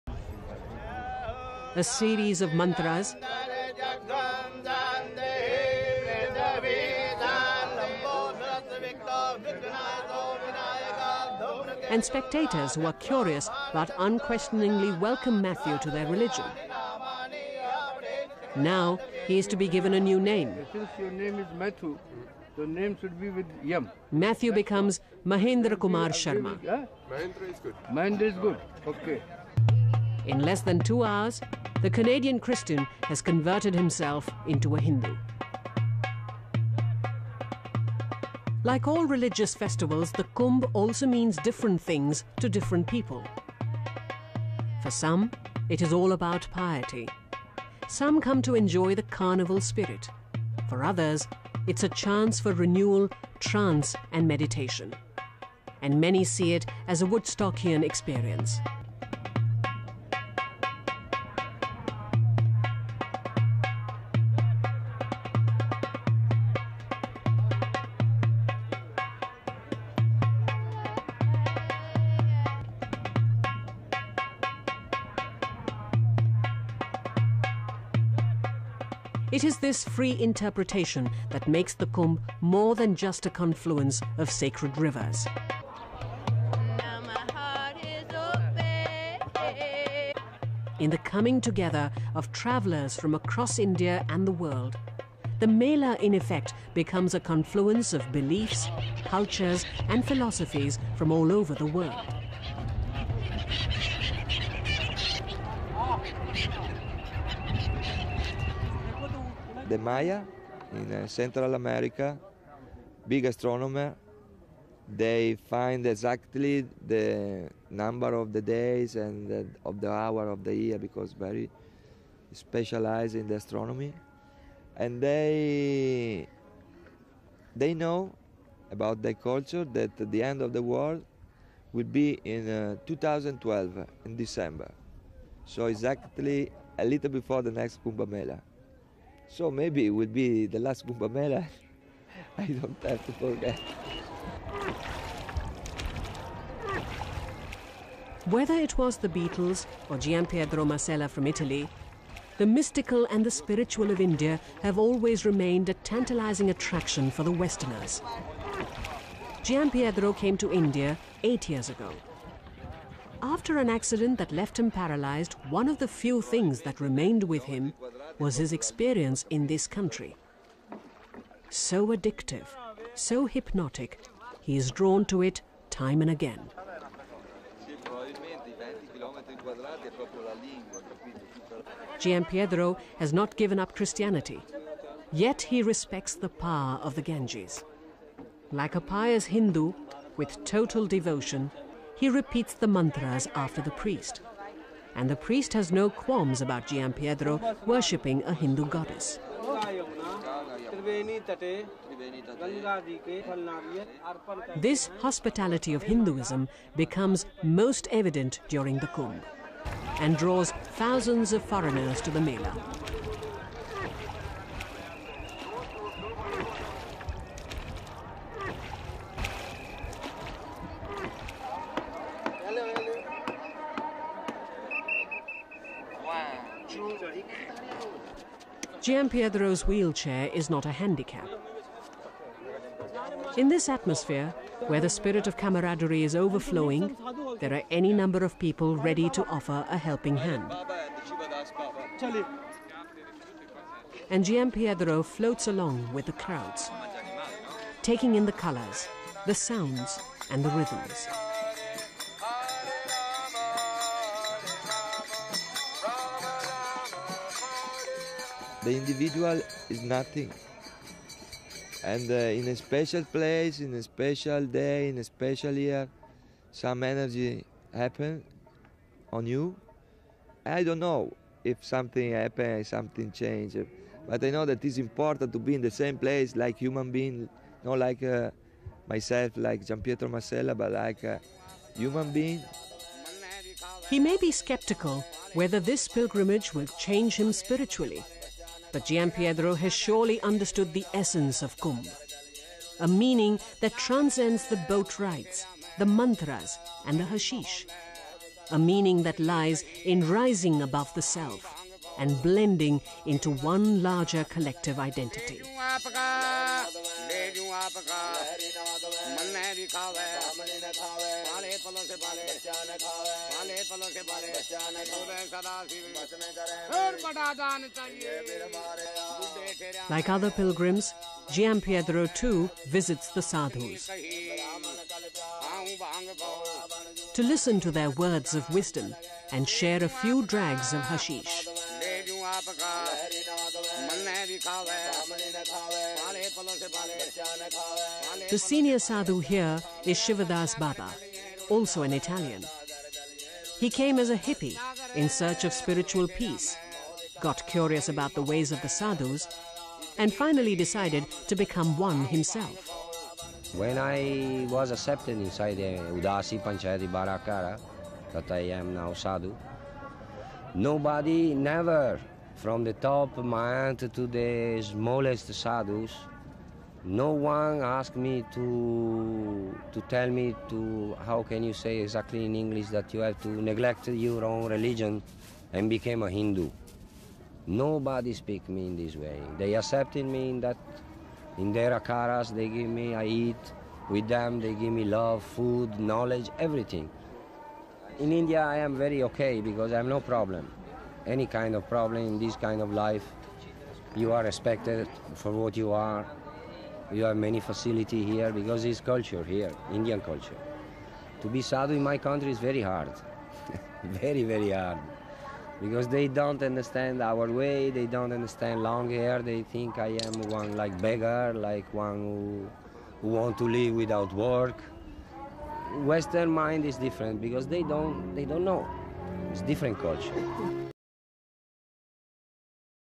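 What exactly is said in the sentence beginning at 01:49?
the Maya in uh, Central America, big astronomer.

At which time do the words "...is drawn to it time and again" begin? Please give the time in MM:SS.
02:54.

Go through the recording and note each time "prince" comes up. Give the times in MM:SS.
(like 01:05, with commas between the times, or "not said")
not said.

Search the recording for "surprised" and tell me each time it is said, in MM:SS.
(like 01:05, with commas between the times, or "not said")
not said.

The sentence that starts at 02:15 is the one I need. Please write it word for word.
So exactly a little before the next Kumbh Mela.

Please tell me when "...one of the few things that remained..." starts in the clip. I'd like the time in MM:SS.
02:45.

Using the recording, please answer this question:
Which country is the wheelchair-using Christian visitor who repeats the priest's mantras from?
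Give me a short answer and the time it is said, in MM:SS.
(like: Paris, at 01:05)
Italy, at 02:31.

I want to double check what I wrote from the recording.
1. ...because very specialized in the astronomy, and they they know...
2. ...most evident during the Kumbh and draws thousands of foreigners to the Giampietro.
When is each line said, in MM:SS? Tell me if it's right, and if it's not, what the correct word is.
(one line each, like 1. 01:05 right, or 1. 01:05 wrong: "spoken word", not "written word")
1. 02:00 right
2. 03:27 wrong: "Mela", not "Giampietro".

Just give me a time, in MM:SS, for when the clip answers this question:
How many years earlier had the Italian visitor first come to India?
02:41.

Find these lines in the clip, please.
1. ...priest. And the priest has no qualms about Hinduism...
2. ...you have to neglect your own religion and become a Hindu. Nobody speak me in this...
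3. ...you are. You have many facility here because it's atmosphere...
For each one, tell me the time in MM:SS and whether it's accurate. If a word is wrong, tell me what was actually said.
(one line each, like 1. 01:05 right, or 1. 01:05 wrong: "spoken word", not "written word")
1. 03:13 wrong: "Giampietro", not "Hinduism"
2. 06:12 right
3. 06:35 wrong: "culture", not "atmosphere".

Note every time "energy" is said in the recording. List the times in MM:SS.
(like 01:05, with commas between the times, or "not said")
04:26.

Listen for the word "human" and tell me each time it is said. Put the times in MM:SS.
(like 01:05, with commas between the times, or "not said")
04:36, 04:41.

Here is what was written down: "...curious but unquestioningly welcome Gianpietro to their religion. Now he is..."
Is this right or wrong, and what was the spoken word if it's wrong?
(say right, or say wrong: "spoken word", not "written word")
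wrong: "Matthew", not "Gianpietro".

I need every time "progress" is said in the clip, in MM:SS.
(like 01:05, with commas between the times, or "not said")
not said.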